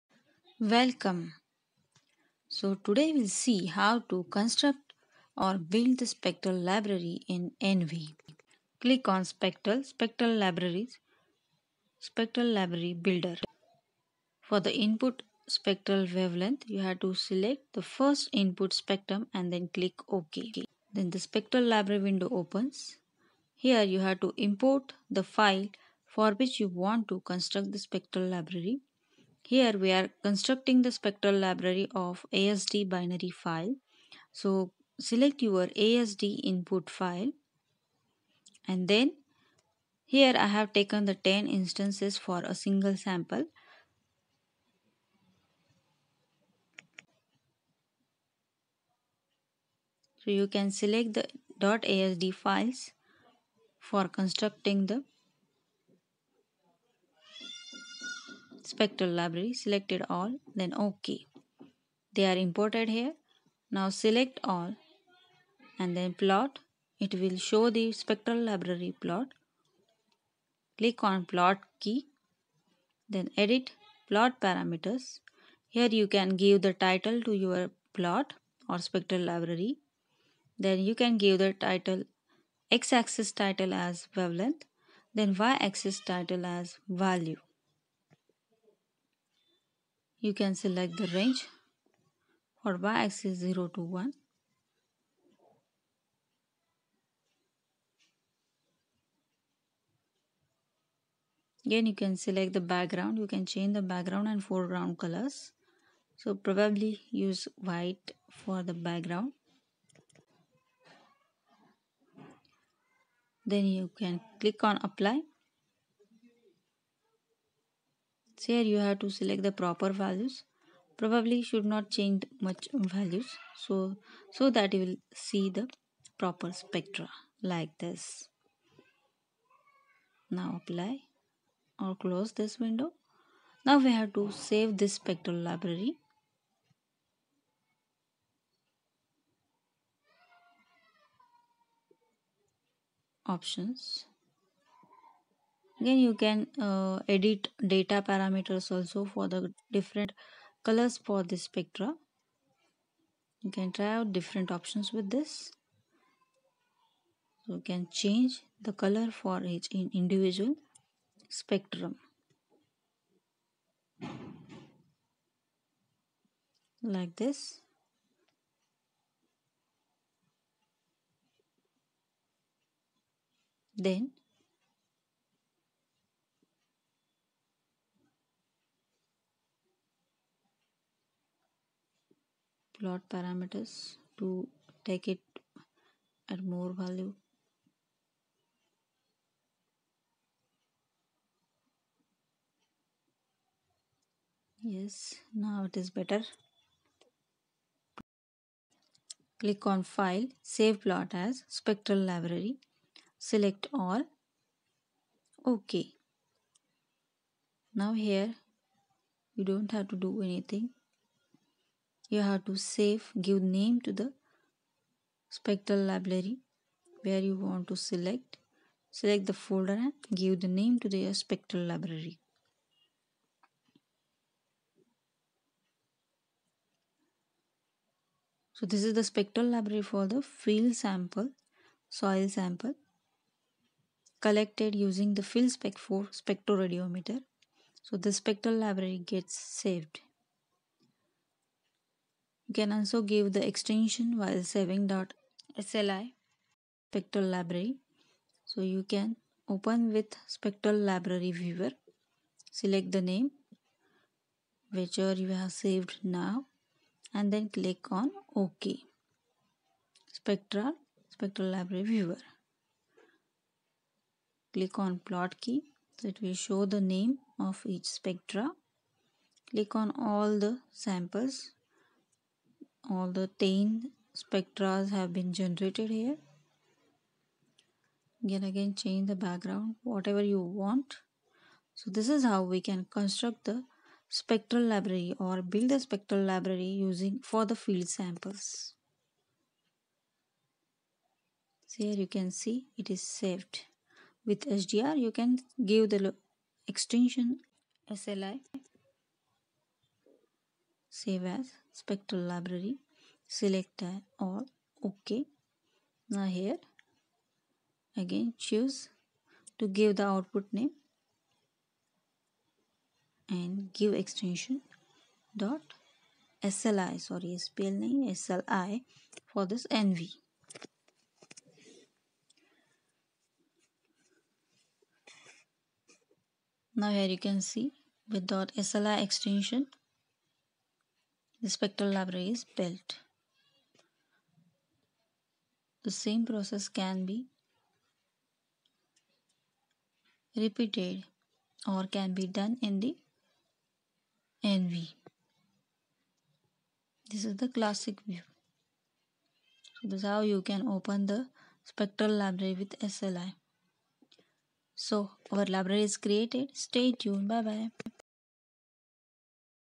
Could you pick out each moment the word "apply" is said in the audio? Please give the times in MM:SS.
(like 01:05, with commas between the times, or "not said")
01:54, 02:10.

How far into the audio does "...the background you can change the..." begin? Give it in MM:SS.
01:42.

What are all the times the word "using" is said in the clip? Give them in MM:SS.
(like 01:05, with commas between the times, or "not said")
03:54, 04:46.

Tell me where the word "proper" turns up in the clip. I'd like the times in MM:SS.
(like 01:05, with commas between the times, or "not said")
01:59, 02:06.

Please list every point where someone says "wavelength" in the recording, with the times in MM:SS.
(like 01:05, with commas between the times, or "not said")
00:16, 01:24.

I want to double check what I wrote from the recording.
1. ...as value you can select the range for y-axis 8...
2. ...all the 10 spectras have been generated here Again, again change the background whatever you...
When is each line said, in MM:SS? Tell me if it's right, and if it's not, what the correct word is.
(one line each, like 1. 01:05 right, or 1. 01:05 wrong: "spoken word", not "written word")
1. 01:26 wrong: "0", not "8"
2. 04:32 right.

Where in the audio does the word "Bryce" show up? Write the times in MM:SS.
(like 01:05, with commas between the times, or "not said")
not said.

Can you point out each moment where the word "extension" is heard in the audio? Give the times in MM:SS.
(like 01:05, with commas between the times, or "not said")
04:03, 04:56, 05:14, 05:29.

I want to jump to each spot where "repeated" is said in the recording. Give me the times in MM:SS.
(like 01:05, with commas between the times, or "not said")
05:40.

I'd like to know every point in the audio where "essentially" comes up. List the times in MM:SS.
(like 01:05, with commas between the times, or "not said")
not said.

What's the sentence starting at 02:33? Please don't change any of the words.
You can try out different options with this.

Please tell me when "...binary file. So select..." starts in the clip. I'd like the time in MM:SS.
00:32.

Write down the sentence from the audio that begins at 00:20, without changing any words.
Then the spectral library window opens.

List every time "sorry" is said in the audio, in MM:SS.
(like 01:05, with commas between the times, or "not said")
05:17.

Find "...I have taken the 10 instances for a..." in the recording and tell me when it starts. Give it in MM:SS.
00:40.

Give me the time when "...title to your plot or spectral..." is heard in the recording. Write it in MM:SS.
01:16.